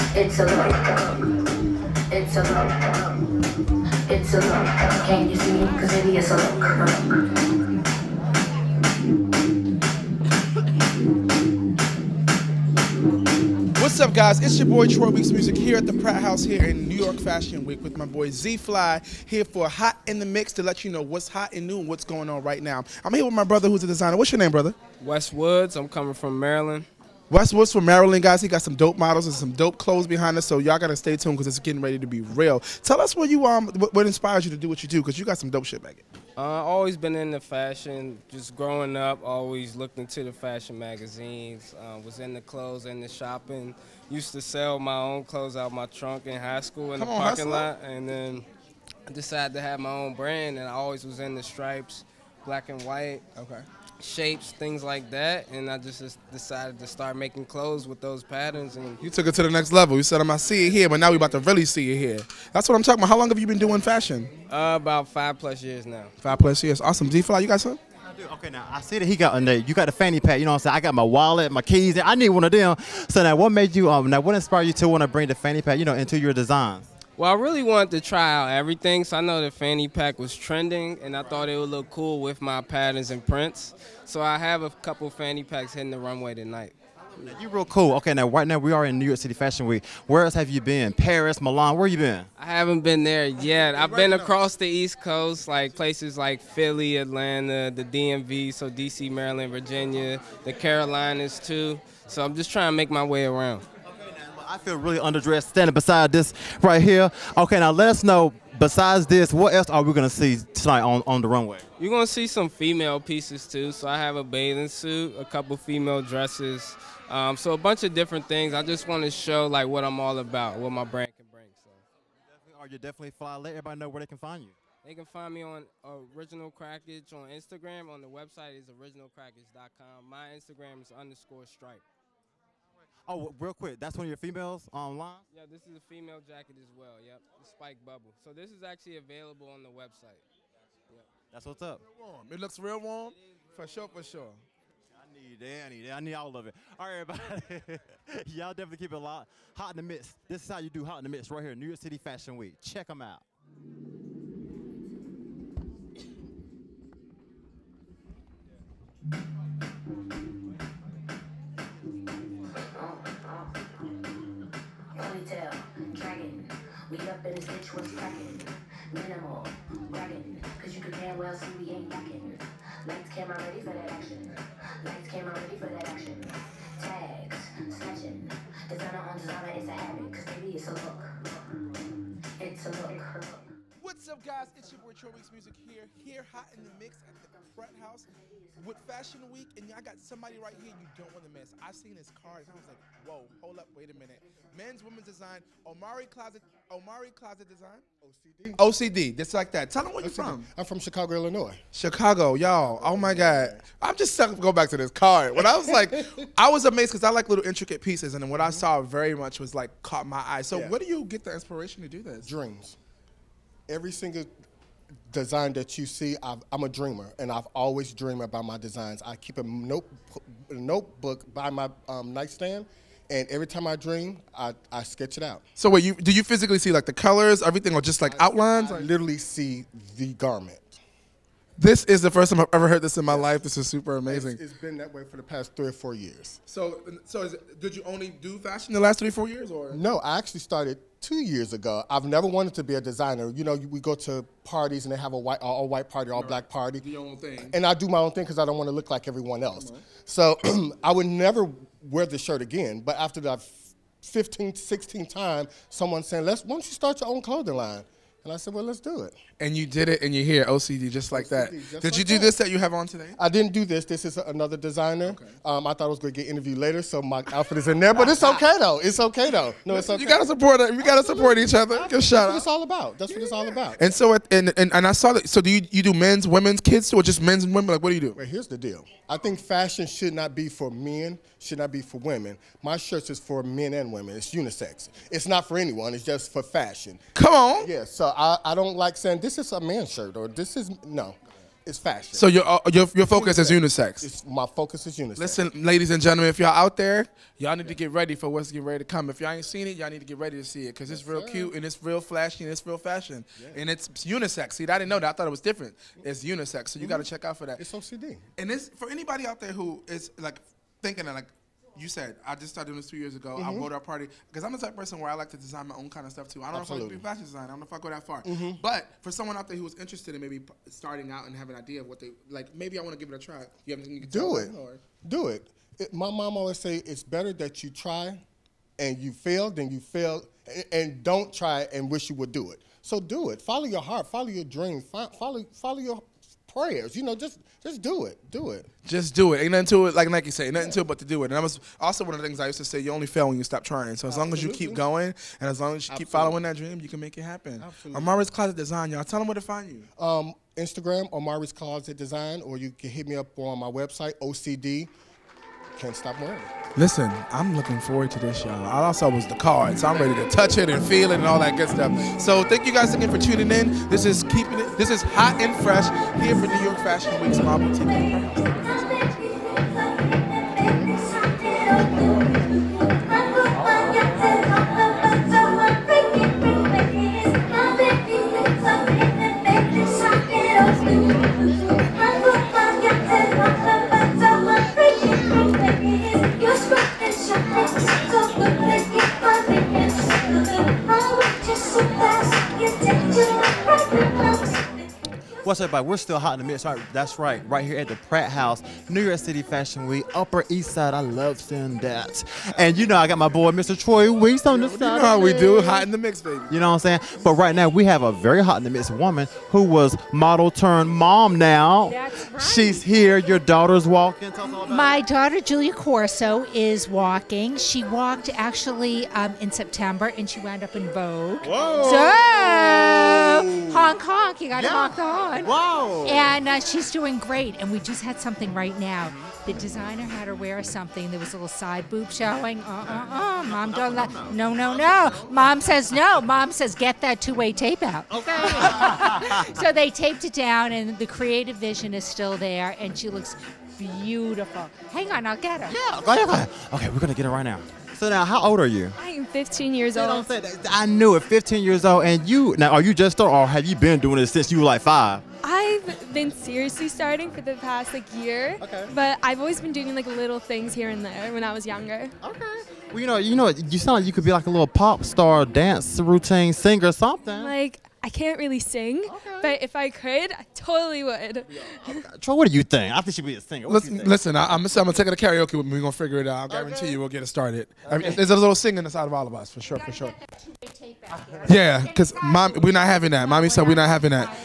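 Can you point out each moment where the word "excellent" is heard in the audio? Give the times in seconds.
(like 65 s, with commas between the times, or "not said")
not said.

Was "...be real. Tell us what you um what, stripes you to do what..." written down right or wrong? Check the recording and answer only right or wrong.
wrong.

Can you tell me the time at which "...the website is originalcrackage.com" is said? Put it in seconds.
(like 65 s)
128 s.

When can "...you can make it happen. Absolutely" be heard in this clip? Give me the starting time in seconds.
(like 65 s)
346 s.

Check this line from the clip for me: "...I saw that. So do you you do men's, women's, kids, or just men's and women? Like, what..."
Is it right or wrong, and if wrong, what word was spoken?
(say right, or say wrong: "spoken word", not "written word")
right.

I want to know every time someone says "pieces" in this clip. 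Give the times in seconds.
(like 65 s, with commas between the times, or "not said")
112 s, 207 s.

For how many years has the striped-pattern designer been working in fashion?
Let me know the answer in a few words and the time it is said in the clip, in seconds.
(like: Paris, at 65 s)
5 plus years, at 64 s.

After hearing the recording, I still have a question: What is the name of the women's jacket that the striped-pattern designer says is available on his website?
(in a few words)
Spike Bubble.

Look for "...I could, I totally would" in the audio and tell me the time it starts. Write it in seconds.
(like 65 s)
469 s.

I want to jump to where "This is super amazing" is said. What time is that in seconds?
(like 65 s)
233 s.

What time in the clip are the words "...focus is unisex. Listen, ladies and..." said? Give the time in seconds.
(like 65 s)
294 s.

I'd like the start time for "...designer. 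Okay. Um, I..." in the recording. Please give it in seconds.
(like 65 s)
264 s.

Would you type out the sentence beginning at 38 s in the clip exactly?
Just growing up, always looked into the fashion magazines.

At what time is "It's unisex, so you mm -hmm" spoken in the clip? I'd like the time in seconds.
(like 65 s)
306 s.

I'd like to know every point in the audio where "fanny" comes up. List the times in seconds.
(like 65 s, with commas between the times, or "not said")
69 s, 75 s, 79 s, 85 s.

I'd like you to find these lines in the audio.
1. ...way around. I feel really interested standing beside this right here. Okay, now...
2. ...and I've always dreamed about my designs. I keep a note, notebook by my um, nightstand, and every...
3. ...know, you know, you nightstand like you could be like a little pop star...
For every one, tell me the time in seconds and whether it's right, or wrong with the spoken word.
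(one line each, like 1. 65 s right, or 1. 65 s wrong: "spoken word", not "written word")
1. 103 s wrong: "underdressed", not "interested"
2. 217 s right
3. 463 s wrong: "sound", not "nightstand".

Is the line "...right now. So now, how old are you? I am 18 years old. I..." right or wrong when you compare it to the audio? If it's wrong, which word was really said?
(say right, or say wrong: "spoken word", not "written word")
wrong: "15", not "18".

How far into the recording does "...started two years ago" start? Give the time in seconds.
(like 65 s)
240 s.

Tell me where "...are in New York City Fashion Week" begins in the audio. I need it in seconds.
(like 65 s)
88 s.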